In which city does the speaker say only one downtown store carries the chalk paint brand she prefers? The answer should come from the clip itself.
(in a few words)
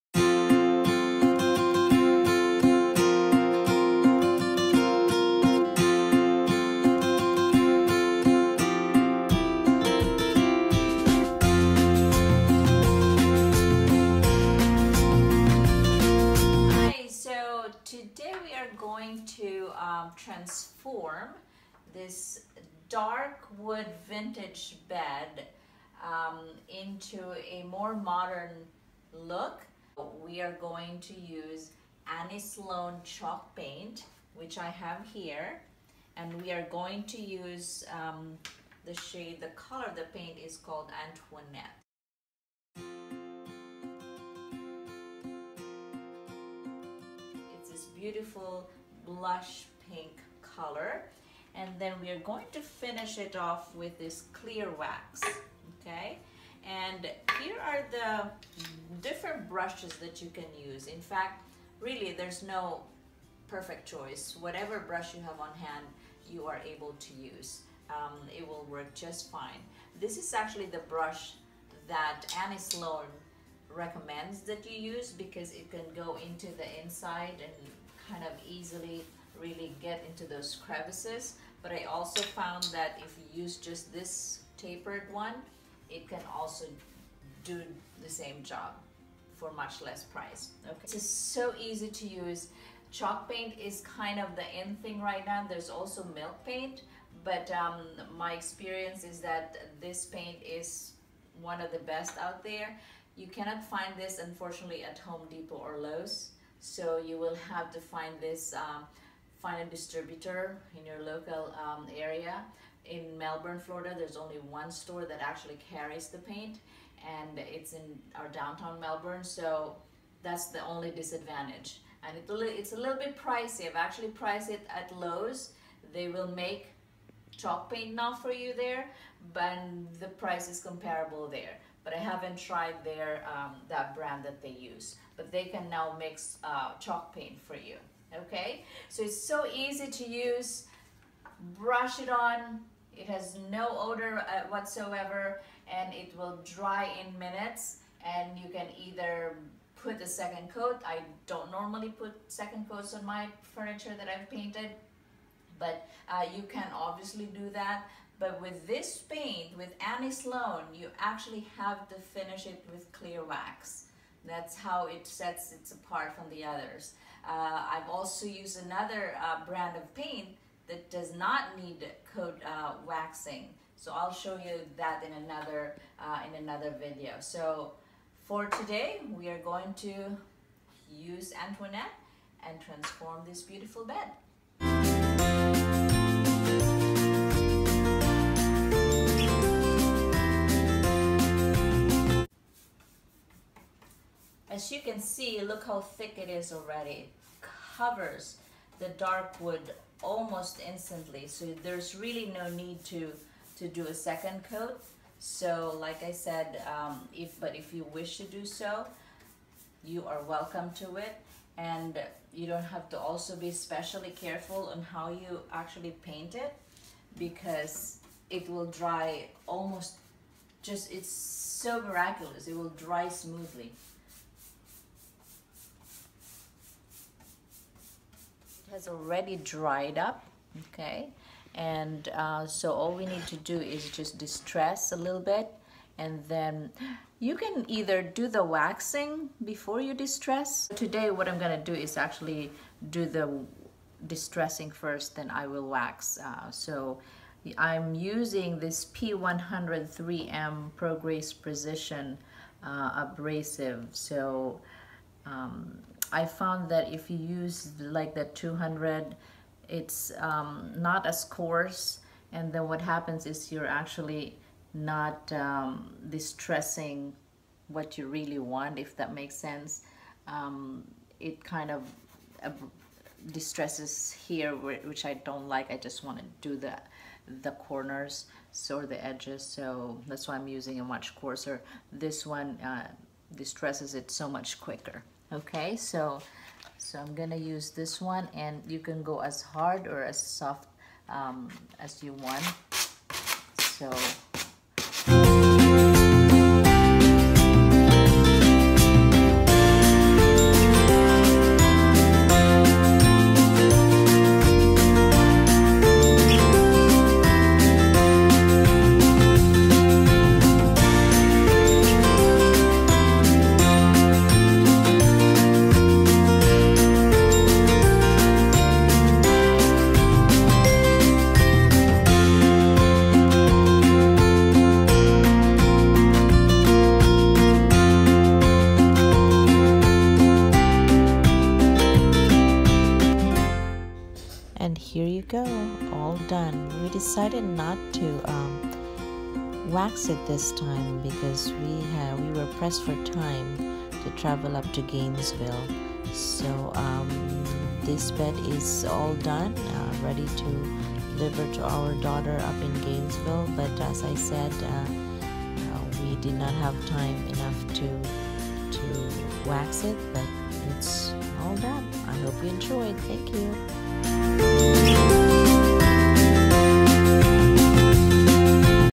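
Melbourne, Florida.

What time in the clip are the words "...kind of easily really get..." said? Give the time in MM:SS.
01:18.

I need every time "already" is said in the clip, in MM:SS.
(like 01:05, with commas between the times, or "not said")
03:16, 03:48.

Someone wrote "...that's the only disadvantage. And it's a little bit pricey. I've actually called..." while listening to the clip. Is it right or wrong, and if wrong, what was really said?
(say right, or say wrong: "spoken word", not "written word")
wrong: "priced", not "called".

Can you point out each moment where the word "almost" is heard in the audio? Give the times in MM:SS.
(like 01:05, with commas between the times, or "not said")
03:20, 03:39.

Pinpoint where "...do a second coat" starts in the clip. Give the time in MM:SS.
03:23.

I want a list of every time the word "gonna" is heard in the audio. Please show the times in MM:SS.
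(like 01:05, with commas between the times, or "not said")
04:01, 04:47.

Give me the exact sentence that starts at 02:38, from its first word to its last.
But with this paint, with Annie Sloan, you actually have to finish it with clear wax.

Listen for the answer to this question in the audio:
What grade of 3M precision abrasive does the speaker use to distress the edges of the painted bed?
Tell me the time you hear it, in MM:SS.
04:08.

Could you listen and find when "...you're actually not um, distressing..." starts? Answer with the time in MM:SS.
04:23.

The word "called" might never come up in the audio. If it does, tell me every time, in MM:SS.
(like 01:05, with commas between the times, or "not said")
00:40.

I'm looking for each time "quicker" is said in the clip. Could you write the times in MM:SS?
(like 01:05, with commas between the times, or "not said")
04:44.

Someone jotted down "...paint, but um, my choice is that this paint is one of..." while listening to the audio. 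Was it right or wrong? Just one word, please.
wrong.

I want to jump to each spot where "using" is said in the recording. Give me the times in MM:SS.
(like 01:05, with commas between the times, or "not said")
04:07, 04:40.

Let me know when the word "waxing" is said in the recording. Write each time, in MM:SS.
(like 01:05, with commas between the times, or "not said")
02:52, 03:58.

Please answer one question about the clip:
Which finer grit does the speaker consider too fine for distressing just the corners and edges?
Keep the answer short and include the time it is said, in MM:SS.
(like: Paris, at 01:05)
200, at 04:18.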